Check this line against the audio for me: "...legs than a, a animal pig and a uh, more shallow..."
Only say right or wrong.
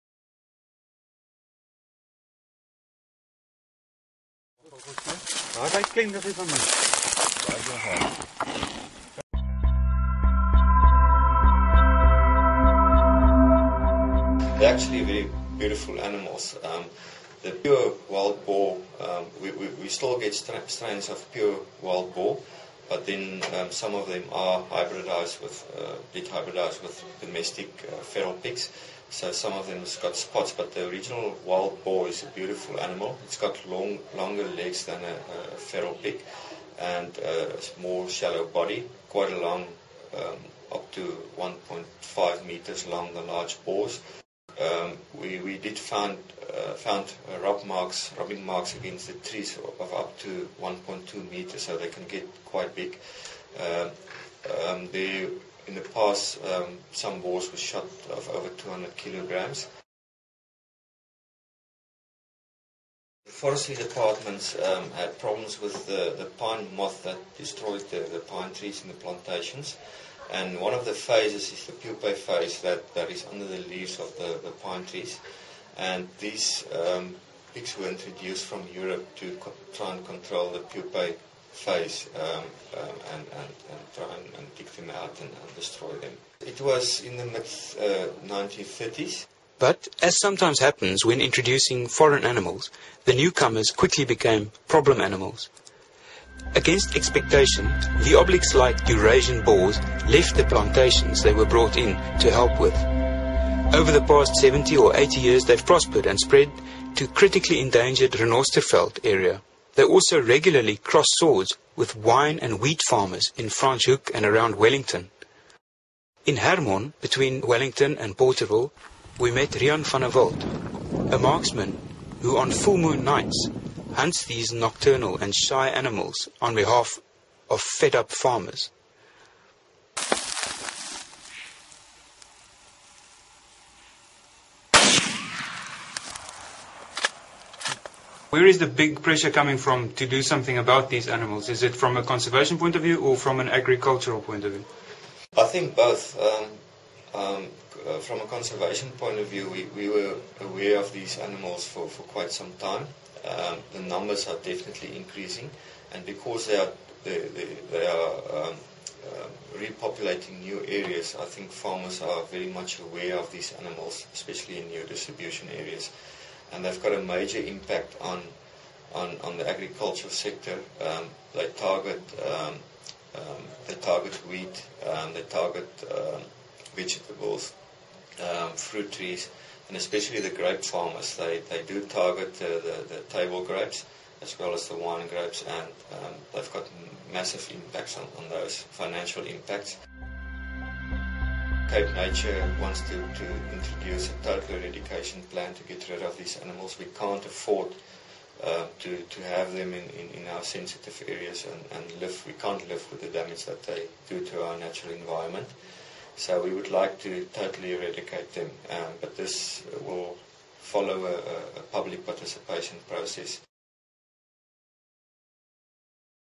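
wrong.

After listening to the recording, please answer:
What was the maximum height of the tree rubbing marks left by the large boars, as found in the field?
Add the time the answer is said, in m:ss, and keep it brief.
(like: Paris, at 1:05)
1.2 meters, at 0:50.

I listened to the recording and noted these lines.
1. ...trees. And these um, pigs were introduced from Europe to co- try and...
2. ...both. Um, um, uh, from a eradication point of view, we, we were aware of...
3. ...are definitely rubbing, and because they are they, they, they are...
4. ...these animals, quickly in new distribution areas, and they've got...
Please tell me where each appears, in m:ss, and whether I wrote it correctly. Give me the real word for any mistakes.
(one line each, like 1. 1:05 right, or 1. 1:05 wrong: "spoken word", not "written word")
1. 1:14 right
2. 2:25 wrong: "conservation", not "eradication"
3. 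2:34 wrong: "increasing", not "rubbing"
4. 2:43 wrong: "especially", not "quickly".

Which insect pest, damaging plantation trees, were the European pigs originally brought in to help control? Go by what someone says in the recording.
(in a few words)
pine moth.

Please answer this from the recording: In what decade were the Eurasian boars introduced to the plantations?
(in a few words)
1930s.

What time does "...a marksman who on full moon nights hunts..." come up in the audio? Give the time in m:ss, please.
2:01.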